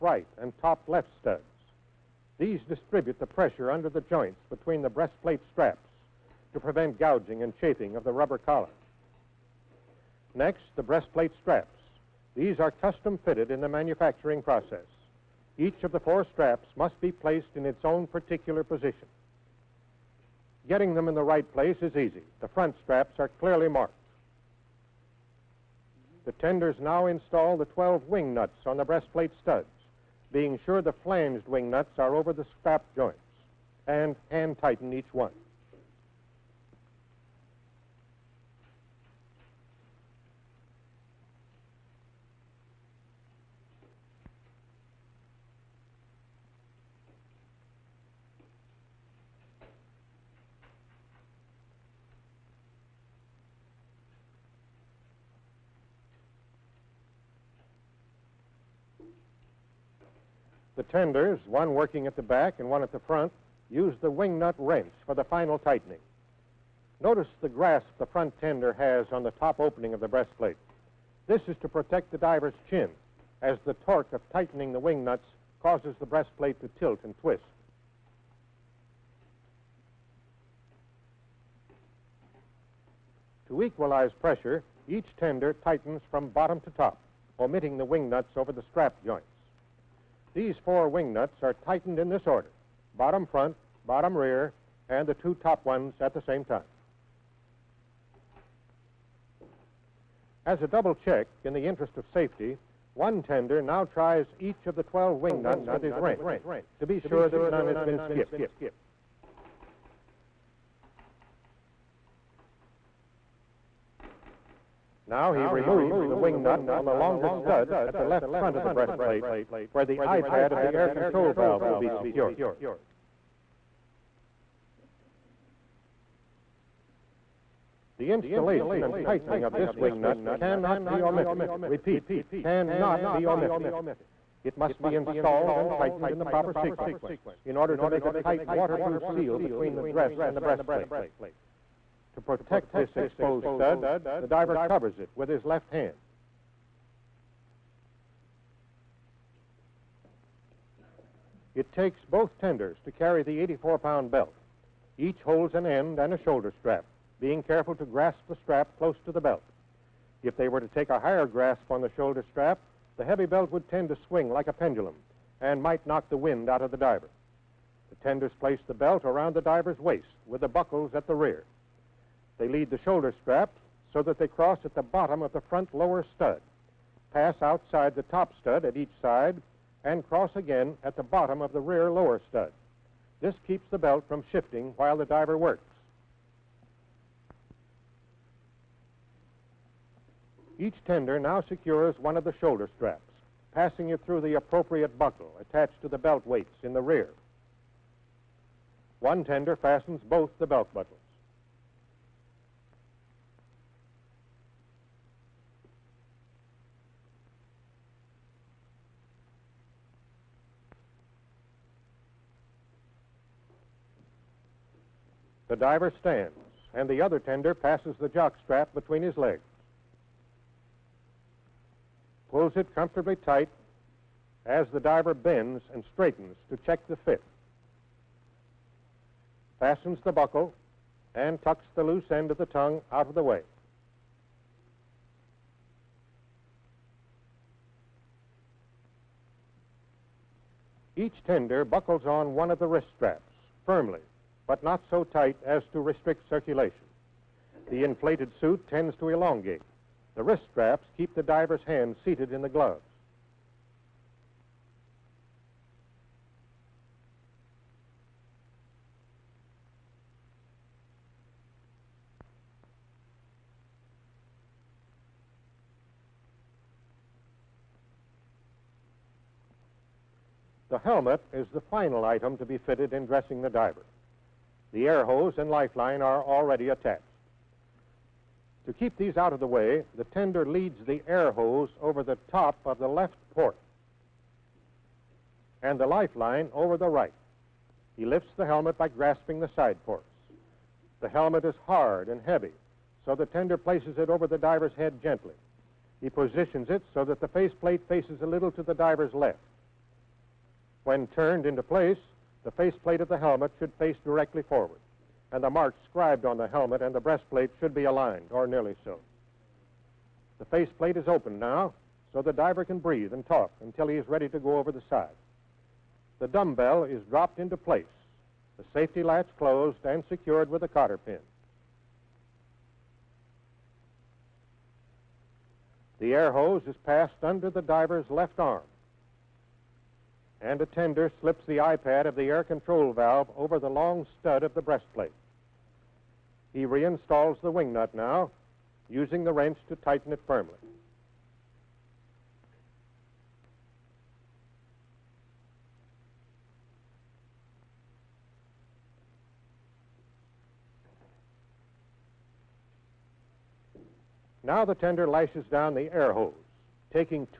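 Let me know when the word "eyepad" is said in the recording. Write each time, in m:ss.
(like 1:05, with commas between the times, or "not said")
2:00, 5:31.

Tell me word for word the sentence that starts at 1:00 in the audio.
tenders, one working at the back and one at the front, use the wing nut wrench for the final tightening.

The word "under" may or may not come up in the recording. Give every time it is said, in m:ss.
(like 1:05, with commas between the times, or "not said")
0:03, 5:27.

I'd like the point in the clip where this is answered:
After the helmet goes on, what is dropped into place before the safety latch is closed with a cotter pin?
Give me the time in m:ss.
5:16.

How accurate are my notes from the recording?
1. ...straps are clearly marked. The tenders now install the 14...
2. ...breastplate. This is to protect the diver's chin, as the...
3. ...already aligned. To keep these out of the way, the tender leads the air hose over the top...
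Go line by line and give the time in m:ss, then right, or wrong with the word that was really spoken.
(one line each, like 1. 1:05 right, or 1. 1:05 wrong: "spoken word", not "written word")
1. 0:22 wrong: "12", not "14"
2. 1:10 right
3. 4:36 wrong: "attached", not "aligned".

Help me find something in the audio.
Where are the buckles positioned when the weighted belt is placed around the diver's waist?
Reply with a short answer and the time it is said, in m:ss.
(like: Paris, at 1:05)
At the rear, at 2:50.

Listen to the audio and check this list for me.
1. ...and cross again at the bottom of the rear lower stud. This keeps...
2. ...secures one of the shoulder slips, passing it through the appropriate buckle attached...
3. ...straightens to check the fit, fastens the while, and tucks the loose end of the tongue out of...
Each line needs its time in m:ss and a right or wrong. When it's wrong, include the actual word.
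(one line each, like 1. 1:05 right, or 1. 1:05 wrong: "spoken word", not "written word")
1. 2:59 right
2. 3:11 wrong: "straps", not "slips"
3. 3:45 wrong: "buckle", not "while".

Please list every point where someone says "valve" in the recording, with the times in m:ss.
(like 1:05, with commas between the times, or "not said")
2:01, 5:32.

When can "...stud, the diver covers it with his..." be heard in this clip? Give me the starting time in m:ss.
2:23.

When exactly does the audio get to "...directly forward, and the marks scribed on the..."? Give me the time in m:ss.
5:04.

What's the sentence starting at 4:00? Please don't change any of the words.
Each tender buckles on one of the wrist straps firmly but not so tight as to restrict circulation.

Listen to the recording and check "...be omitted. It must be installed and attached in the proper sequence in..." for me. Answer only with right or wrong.
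wrong.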